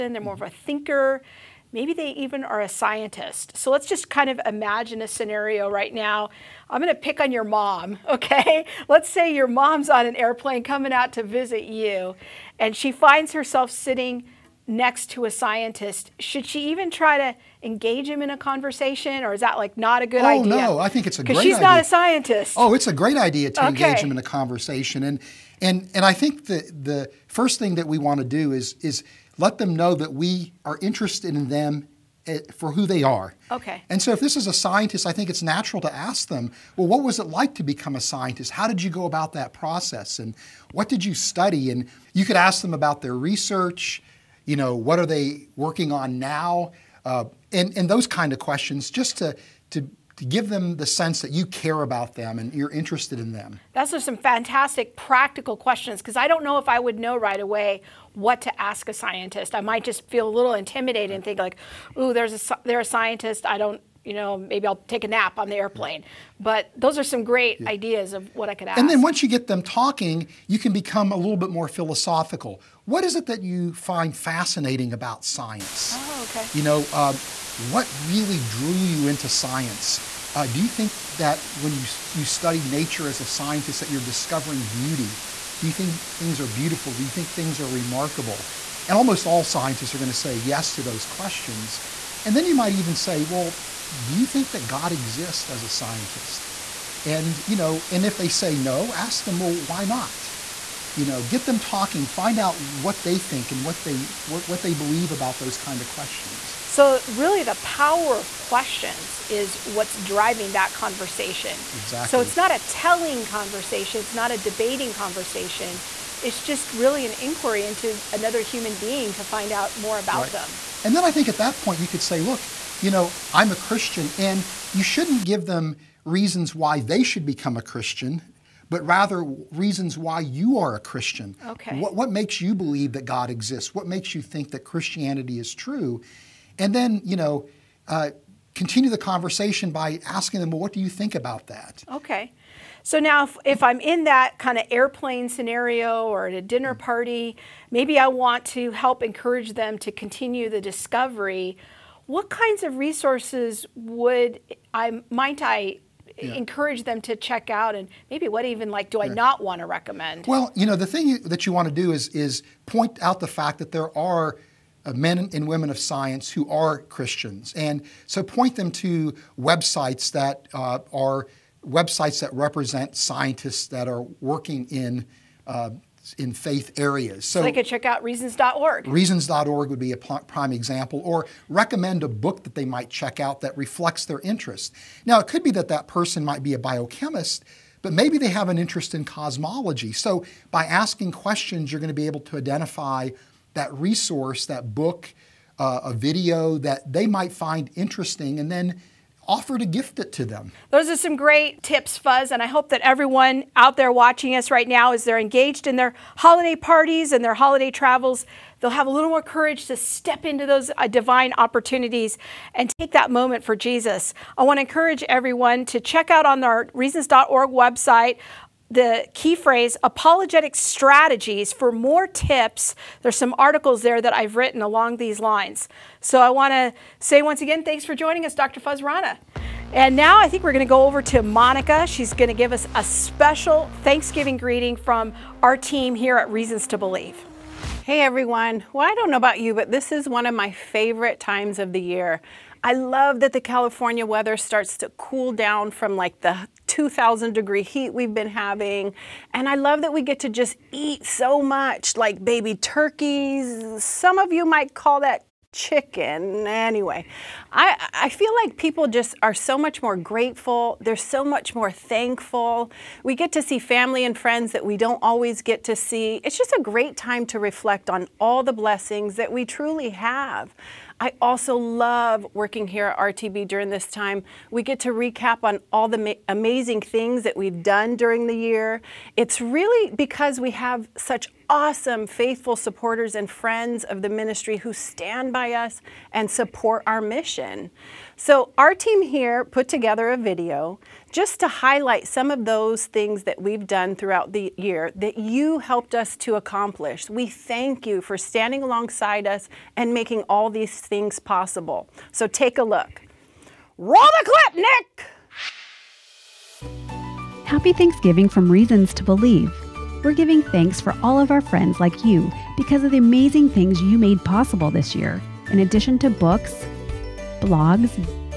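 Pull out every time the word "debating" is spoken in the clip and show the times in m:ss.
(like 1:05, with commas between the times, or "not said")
1:54.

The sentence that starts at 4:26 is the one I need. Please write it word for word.
It's just a great time to reflect on all the blessings that we truly have.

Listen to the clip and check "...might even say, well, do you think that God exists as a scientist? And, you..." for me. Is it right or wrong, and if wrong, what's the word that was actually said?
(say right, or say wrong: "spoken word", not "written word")
right.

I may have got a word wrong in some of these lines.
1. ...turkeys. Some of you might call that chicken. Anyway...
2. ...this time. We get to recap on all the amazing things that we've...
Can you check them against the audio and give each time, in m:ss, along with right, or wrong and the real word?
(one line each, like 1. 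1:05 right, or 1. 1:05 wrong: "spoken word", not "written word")
1. 4:12 right
2. 4:33 right.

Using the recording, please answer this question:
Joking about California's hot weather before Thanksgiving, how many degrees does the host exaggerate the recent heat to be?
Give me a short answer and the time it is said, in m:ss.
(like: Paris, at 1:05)
2,000 degrees, at 4:06.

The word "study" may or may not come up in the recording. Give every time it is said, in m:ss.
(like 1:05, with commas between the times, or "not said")
0:41, 1:22.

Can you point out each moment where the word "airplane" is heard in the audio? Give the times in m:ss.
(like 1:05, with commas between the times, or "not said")
0:10, 1:05, 2:24.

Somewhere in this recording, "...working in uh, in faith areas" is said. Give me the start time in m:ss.
2:54.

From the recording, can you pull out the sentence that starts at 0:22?
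Oh, it's a great idea to okay.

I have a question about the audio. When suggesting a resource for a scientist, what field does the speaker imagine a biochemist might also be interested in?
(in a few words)
Cosmology.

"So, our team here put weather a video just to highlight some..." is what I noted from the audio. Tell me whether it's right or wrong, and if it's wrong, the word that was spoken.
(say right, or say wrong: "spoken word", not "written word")
wrong: "together", not "weather".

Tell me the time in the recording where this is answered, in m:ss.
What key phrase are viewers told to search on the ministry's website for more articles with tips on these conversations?
3:39.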